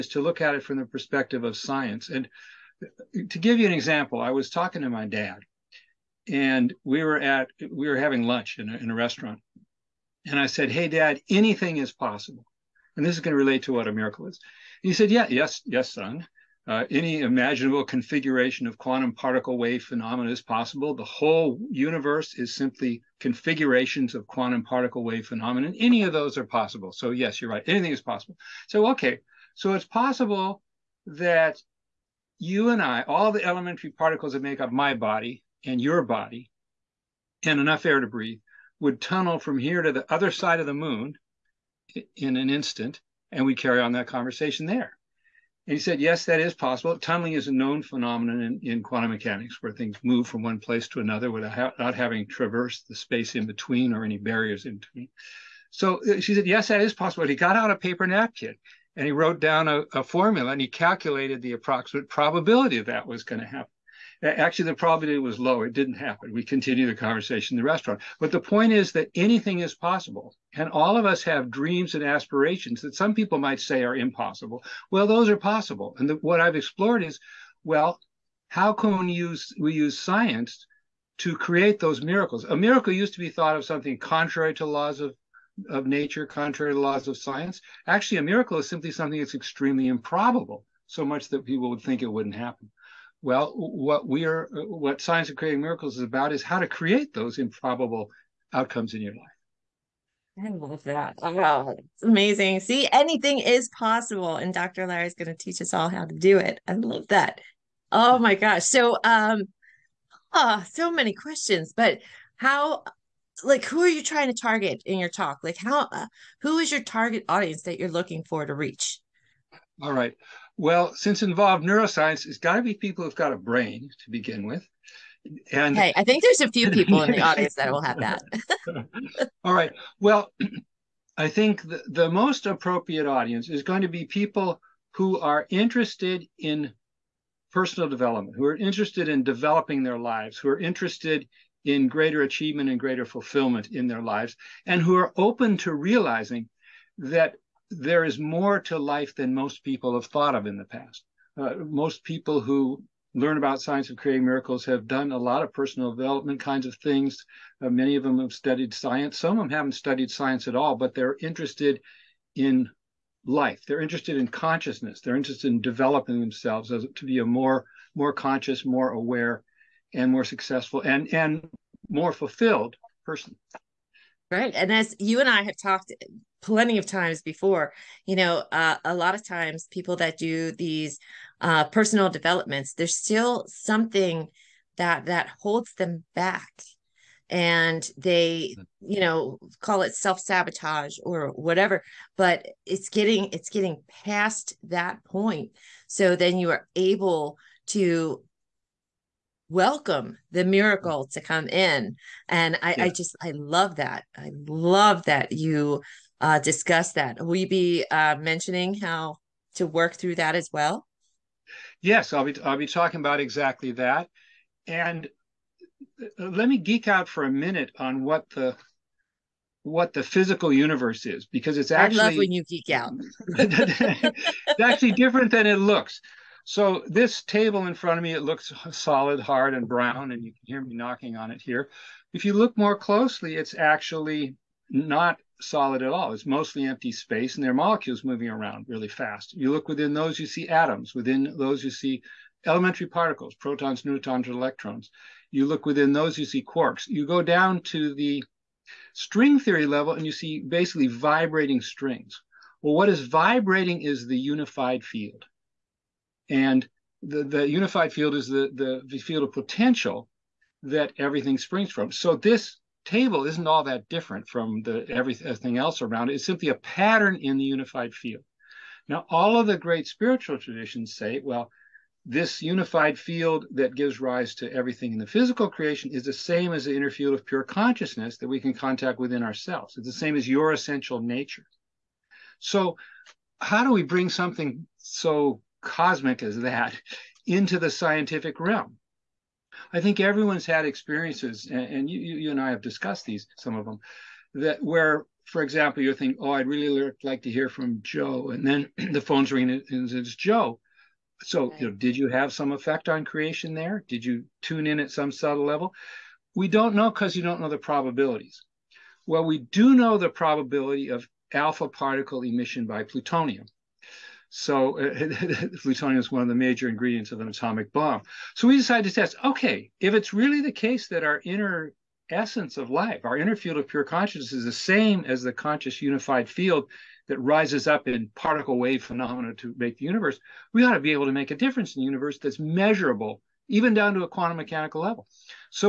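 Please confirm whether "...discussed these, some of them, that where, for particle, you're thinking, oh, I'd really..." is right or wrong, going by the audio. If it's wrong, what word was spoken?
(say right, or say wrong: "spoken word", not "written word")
wrong: "example", not "particle".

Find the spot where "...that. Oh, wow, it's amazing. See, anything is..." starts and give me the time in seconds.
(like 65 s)
100 s.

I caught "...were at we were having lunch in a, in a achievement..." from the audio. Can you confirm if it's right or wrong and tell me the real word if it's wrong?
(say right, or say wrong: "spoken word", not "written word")
wrong: "restaurant", not "achievement".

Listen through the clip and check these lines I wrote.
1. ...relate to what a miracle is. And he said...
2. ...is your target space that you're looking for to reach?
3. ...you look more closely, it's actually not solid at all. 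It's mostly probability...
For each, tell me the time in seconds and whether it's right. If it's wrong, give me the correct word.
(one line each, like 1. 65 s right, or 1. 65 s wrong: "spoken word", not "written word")
1. 13 s right
2. 116 s wrong: "audience", not "space"
3. 232 s wrong: "empty", not "probability".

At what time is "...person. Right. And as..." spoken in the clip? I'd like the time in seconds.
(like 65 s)
173 s.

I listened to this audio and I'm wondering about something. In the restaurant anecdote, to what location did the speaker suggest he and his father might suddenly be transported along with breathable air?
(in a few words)
the other side of the moon.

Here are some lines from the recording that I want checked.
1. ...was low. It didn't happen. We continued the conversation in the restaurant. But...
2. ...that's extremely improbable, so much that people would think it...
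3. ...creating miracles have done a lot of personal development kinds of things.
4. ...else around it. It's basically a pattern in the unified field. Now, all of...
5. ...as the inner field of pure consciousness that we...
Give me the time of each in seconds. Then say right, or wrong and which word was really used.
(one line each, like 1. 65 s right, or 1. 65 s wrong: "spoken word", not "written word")
1. 65 s right
2. 89 s right
3. 153 s right
4. 265 s wrong: "simply", not "basically"
5. 276 s right.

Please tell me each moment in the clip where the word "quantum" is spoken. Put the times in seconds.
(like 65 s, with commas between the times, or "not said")
18 s, 24 s, 48 s, 334 s.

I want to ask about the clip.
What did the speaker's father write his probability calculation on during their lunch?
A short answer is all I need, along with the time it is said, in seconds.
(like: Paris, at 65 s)
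a paper napkin, at 57 s.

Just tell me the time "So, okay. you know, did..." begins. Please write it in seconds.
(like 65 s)
301 s.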